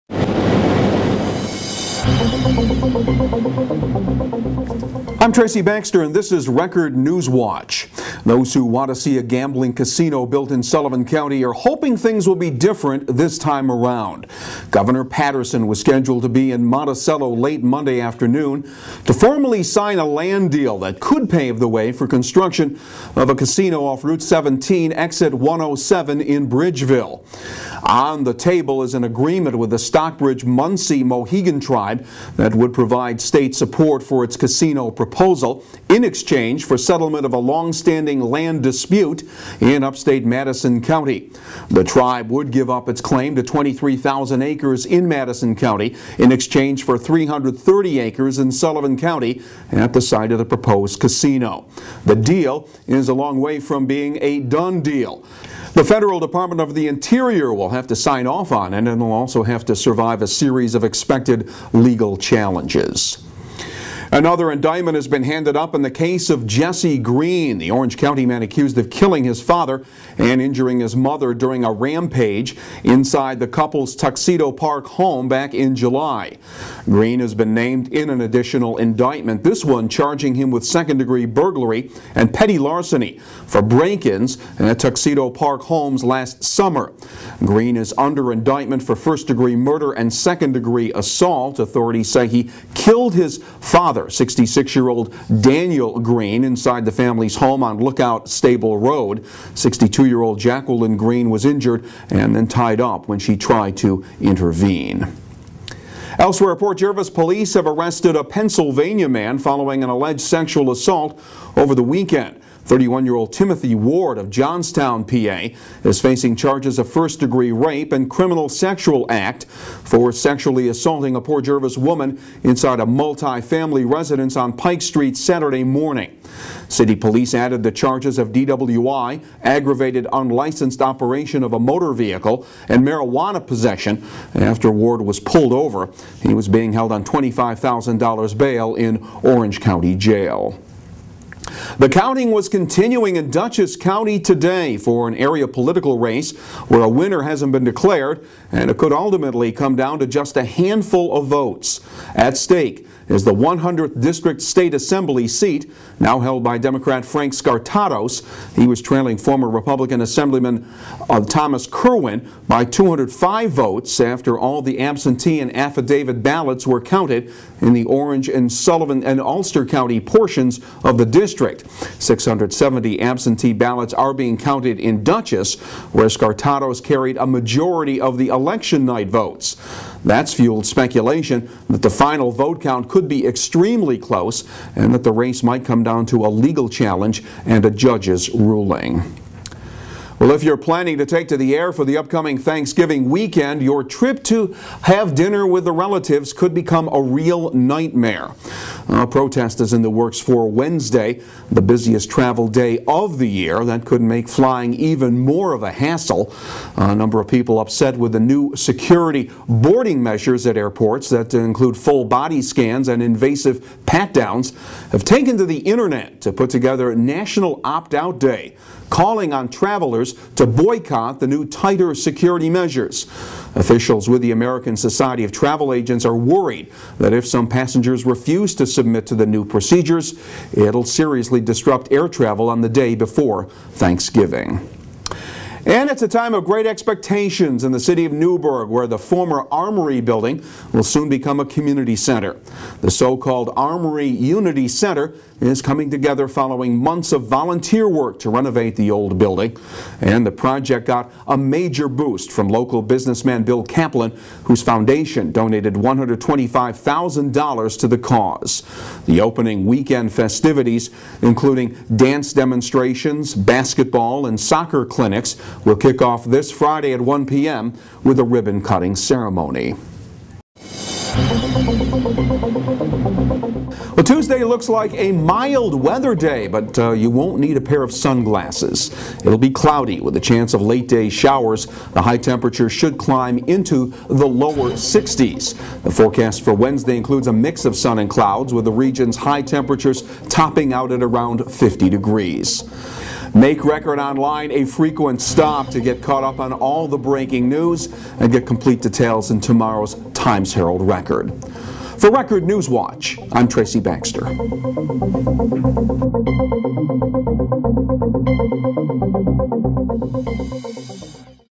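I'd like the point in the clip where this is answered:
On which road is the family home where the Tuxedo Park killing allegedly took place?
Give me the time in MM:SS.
01:37.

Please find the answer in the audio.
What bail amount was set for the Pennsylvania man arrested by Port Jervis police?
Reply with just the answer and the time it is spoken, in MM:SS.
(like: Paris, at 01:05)
$25,000, at 02:17.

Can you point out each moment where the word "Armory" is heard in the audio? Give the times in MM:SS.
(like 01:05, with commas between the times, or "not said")
03:59, 04:03.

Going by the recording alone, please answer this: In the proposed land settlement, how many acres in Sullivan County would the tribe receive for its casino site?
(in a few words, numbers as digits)
330.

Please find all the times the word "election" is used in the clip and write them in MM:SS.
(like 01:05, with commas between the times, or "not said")
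02:58.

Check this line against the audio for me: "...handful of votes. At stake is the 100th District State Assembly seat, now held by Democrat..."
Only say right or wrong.
right.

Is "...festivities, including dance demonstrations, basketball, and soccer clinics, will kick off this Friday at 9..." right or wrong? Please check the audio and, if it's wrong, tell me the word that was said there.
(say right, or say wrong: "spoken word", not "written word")
wrong: "1", not "9".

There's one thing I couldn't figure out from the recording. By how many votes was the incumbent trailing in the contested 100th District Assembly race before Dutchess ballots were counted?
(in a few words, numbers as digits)
205.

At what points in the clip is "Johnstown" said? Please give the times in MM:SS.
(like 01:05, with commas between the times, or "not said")
01:54.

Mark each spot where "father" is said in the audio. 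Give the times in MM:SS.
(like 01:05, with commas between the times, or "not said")
01:09, 01:33.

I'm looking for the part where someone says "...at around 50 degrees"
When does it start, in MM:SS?
04:50.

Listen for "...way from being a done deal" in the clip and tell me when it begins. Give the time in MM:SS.
00:53.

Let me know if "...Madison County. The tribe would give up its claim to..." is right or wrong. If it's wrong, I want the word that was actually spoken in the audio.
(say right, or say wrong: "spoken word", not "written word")
right.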